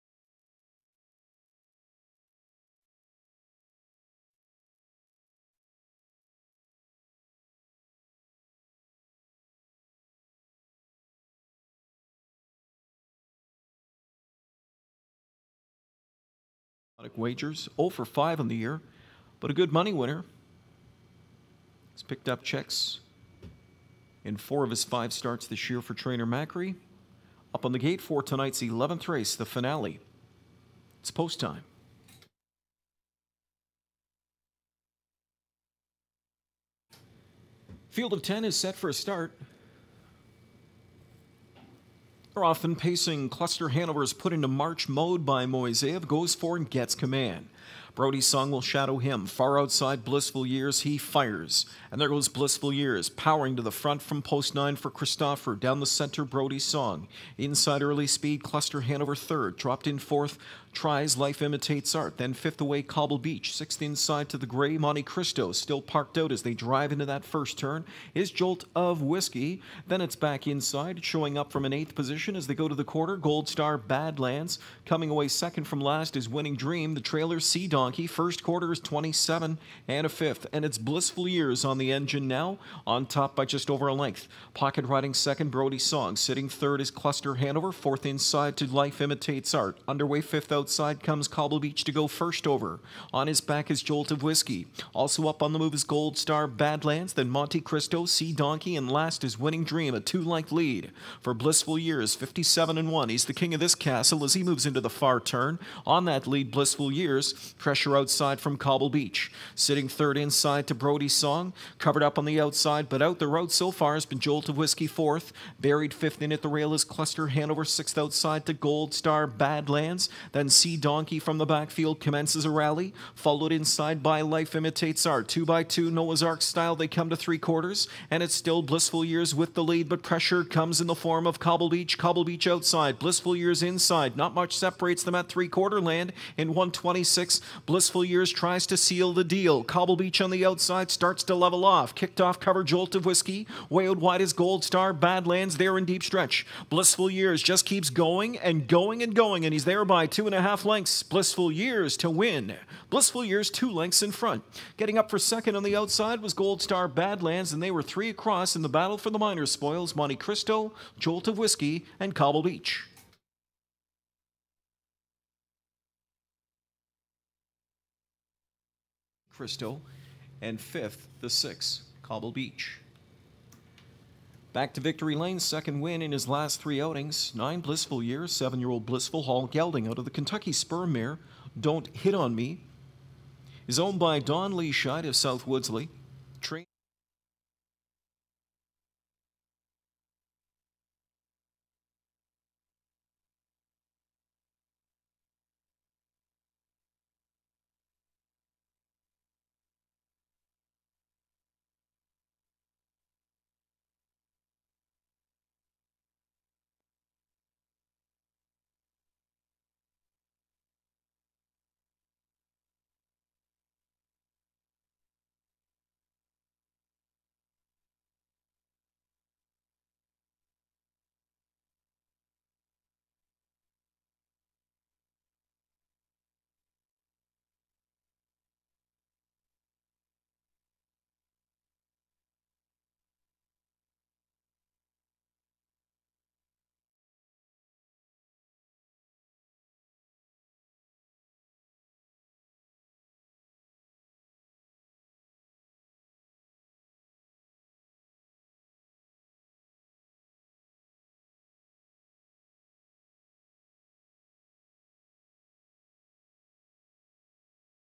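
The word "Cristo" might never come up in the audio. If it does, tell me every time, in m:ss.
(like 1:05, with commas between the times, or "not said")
1:05, 1:37, 2:40.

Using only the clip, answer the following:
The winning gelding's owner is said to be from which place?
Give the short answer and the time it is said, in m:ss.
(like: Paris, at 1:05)
South Woodslee, at 3:05.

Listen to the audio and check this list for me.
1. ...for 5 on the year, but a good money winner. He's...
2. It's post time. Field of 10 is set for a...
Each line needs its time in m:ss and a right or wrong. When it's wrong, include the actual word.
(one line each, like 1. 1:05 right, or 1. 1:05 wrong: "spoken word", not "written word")
1. 0:17 right
2. 0:31 right.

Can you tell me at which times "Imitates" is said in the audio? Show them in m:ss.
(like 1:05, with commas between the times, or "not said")
1:01, 1:29, 2:04.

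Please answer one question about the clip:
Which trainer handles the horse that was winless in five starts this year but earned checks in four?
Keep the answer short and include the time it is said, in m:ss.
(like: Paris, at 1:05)
Macri, at 0:26.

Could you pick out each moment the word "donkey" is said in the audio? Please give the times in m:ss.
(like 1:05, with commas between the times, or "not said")
1:17, 1:38, 2:00.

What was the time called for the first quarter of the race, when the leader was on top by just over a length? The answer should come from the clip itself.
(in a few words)
27 and a fifth.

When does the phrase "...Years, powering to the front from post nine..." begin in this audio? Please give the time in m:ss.
0:52.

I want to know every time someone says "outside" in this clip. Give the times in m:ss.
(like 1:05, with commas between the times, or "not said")
0:49, 1:30, 1:47, 1:52, 1:57, 2:12, 2:20, 2:35.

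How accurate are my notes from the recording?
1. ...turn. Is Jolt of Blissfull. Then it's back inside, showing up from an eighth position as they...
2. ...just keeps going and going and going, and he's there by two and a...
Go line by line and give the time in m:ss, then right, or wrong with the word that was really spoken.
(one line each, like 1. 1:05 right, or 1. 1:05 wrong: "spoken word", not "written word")
1. 1:07 wrong: "Whiskey", not "Blissfull"
2. 2:27 right.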